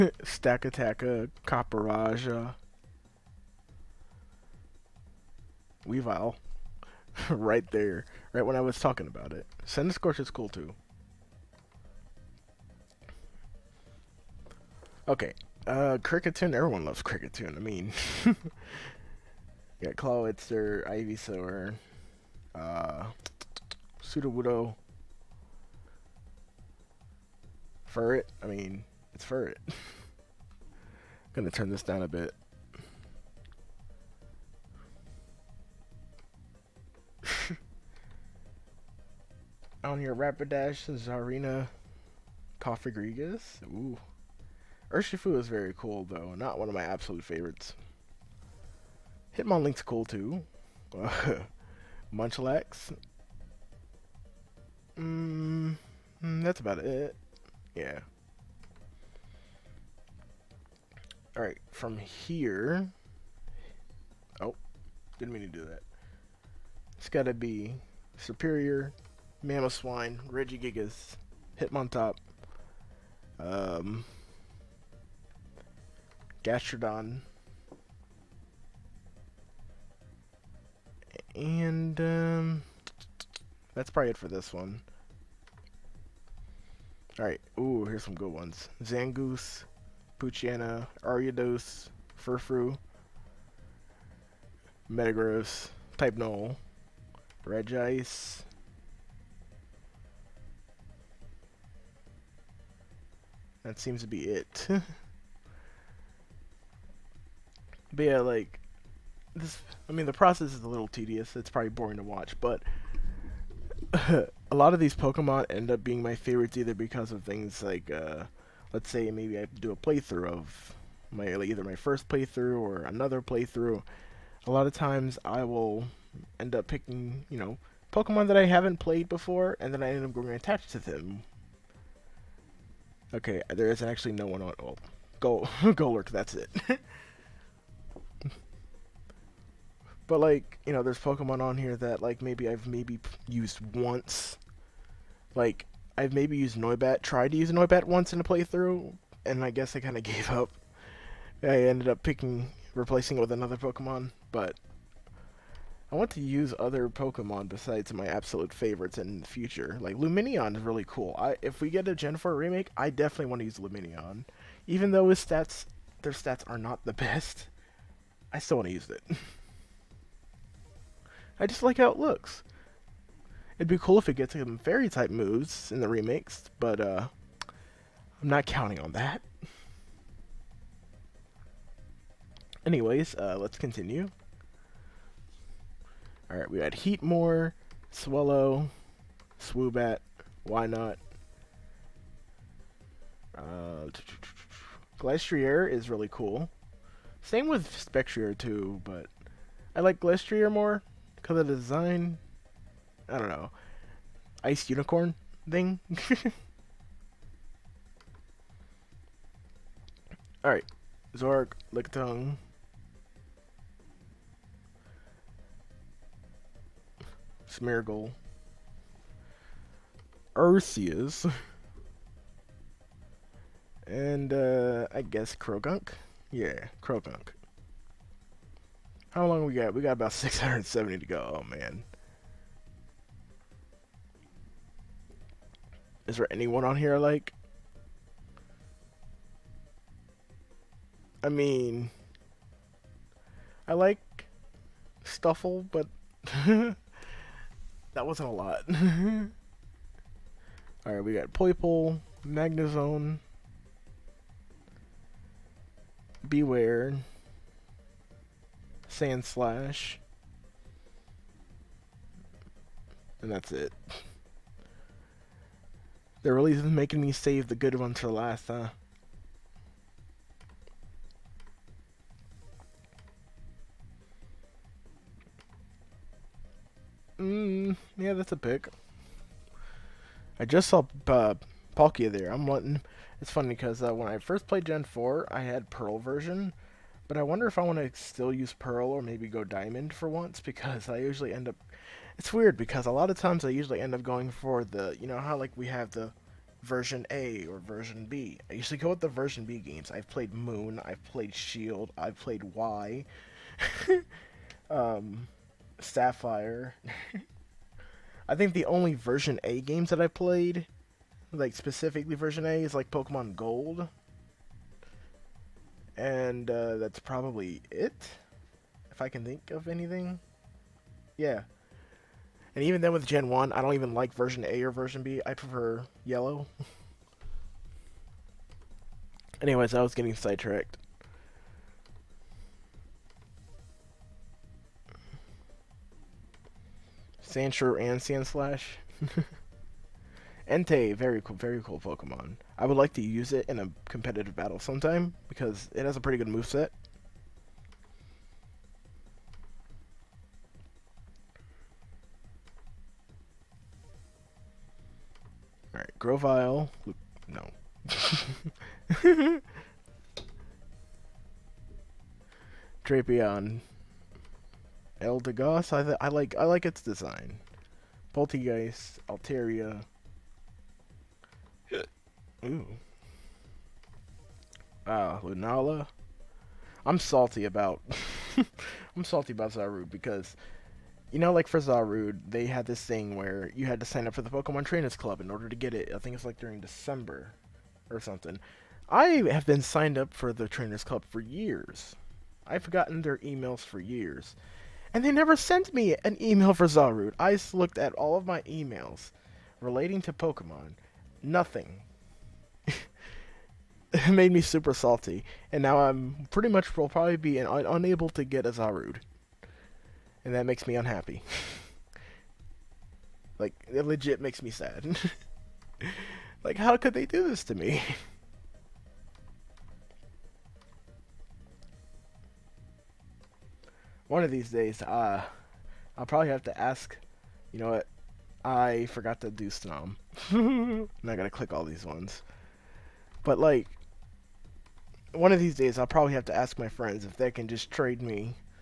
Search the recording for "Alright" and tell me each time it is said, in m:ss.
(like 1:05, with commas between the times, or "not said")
1:01, 1:27, 3:06, 3:30, 4:10, 5:55.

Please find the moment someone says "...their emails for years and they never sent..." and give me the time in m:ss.
6:33.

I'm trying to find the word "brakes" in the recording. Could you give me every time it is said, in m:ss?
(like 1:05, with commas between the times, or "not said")
not said.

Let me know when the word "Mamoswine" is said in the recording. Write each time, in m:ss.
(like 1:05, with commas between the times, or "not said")
1:09.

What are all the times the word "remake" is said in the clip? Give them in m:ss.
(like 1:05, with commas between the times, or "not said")
2:42, 2:55.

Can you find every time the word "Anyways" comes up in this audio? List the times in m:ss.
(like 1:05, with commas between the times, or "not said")
3:02, 5:29.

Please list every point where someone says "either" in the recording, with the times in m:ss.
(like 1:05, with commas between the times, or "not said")
1:56, 2:01.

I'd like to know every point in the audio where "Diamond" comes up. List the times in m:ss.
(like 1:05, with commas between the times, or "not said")
4:49.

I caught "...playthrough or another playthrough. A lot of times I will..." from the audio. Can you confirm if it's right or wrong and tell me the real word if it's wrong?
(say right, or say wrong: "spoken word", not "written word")
right.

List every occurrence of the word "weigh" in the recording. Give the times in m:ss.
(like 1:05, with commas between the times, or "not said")
not said.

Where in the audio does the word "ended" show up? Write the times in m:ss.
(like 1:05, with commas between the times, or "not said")
2:31.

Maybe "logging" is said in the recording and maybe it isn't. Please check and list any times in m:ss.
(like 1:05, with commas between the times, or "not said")
not said.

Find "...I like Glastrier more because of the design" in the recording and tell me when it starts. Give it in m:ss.
3:19.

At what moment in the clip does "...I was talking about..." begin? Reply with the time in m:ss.
0:08.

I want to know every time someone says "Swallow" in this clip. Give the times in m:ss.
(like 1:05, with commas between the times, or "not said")
3:07.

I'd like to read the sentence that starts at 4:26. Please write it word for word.
The release is making me save the good ones for last, huh?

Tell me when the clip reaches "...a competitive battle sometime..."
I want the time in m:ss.
5:43.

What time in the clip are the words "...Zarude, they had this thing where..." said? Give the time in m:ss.
6:21.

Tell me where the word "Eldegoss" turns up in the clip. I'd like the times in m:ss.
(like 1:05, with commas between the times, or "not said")
6:05.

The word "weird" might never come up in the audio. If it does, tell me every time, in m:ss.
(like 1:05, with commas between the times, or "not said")
4:52.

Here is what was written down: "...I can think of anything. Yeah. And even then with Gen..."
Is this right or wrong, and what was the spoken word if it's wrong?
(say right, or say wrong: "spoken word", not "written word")
right.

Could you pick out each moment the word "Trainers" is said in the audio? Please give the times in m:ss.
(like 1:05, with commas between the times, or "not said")
6:24, 6:30.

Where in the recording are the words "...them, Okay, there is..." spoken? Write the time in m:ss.
2:10.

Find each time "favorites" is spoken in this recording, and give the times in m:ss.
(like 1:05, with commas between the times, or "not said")
0:47, 1:56, 2:38.